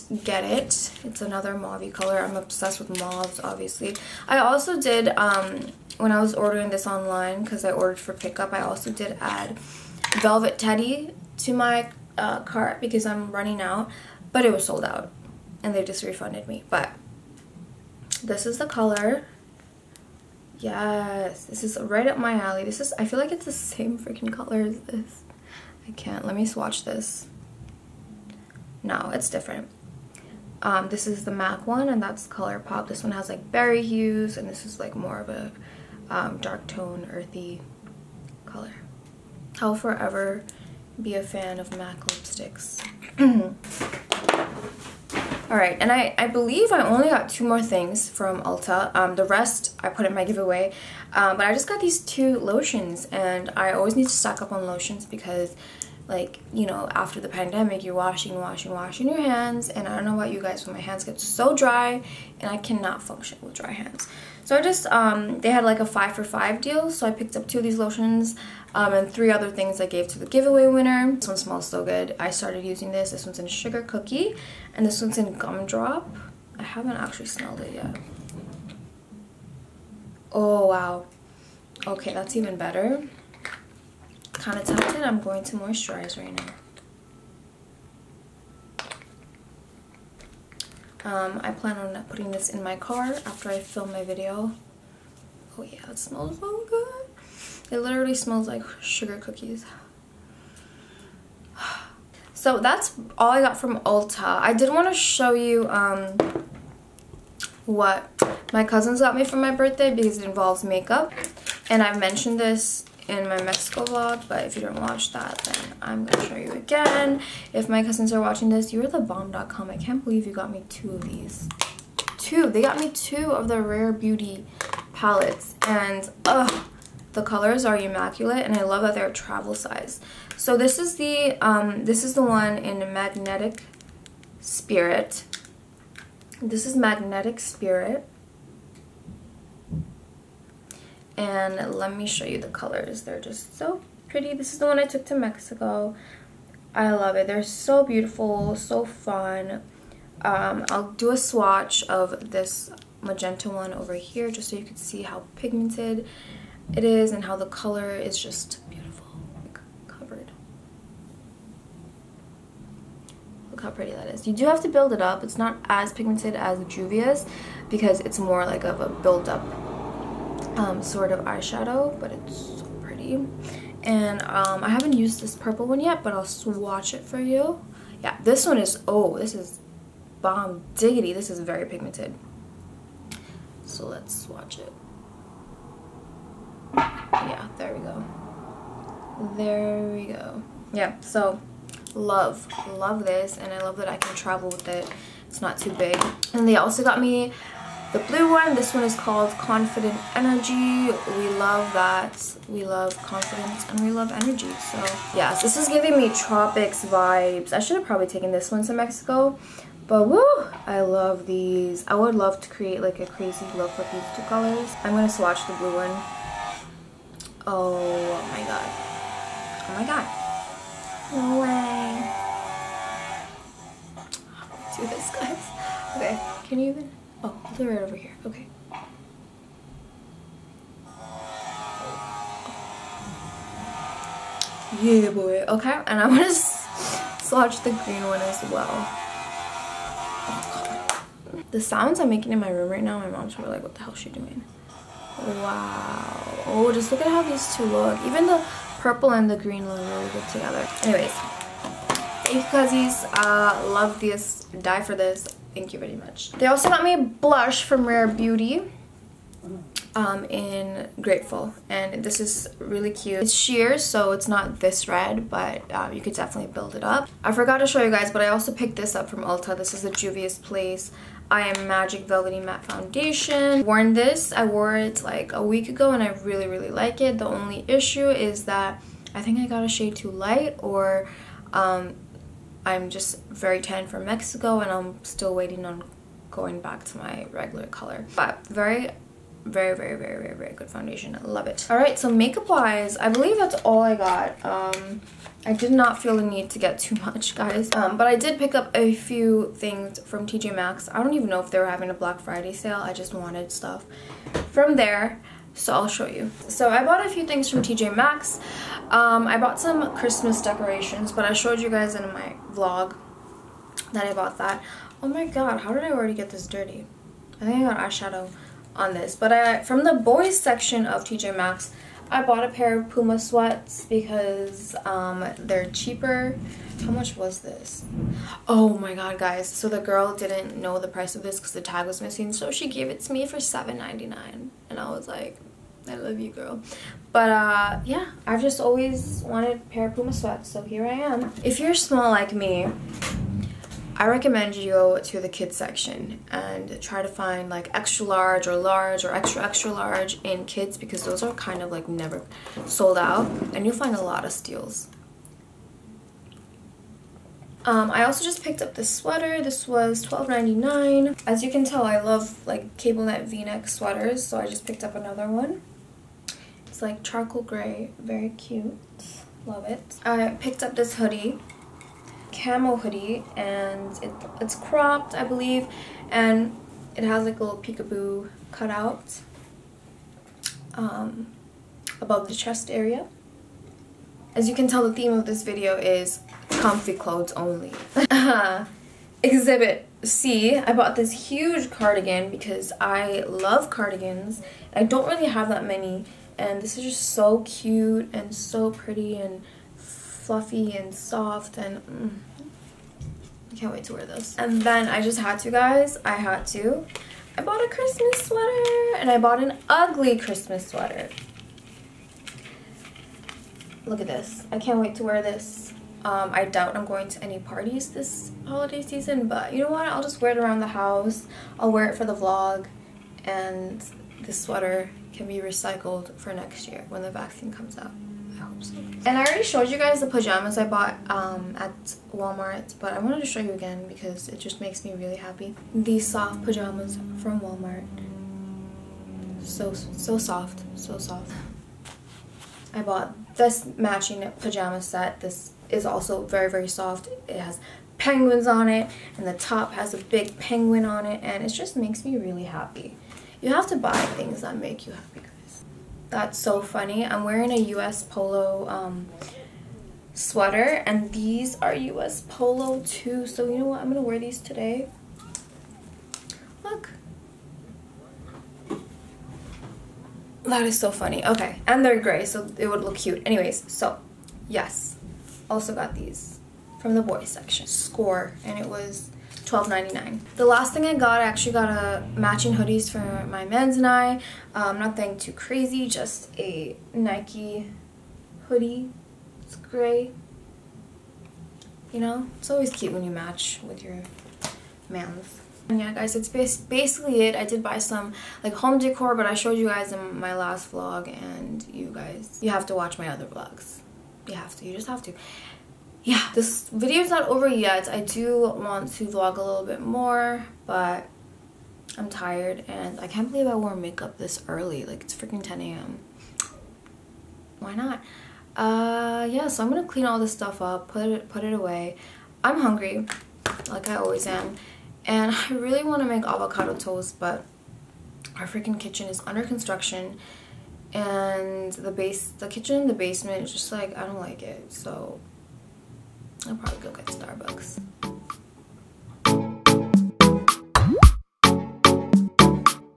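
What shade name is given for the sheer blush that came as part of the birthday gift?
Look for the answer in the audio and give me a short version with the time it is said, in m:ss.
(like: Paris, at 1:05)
Grateful, at 4:20.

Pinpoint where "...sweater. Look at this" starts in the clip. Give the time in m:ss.
6:50.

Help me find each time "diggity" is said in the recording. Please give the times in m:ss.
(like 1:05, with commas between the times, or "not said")
3:00.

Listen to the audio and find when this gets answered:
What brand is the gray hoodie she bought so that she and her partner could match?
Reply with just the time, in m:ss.
8:06.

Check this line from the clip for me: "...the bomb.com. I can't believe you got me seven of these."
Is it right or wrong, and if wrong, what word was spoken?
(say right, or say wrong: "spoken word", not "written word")
wrong: "two", not "seven".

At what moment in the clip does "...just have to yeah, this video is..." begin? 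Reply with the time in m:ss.
8:24.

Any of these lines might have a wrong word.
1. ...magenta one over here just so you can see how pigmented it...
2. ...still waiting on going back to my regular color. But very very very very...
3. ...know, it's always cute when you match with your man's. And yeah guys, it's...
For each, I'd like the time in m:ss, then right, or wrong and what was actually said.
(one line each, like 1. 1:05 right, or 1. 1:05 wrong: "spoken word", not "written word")
1. 2:33 right
2. 4:45 right
3. 8:11 right.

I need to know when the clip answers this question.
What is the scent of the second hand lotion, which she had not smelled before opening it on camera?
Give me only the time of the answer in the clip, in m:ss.
1:15.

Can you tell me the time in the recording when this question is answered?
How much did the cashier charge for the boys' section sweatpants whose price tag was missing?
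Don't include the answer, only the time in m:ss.
5:33.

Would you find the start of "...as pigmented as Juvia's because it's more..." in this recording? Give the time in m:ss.
2:45.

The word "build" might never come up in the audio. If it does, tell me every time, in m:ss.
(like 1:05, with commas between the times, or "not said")
2:44, 2:48, 4:26.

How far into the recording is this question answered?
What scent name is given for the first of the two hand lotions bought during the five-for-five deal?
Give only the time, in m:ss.
1:13.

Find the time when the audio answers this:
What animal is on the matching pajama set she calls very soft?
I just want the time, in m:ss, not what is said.
7:27.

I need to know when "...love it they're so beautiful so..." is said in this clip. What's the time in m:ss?
2:26.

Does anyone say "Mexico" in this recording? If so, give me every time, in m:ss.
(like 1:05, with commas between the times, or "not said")
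1:53, 2:25, 3:28, 4:44.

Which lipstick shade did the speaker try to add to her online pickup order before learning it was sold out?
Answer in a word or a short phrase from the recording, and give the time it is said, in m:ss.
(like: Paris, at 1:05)
Velvet Teddy, at 0:10.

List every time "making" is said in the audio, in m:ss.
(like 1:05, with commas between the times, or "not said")
4:02.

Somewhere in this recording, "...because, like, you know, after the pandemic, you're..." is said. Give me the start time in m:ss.
0:55.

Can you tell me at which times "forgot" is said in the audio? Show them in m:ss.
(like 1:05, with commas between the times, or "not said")
4:27.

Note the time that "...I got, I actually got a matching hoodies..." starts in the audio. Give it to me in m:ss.
8:00.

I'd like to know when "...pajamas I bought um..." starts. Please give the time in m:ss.
7:10.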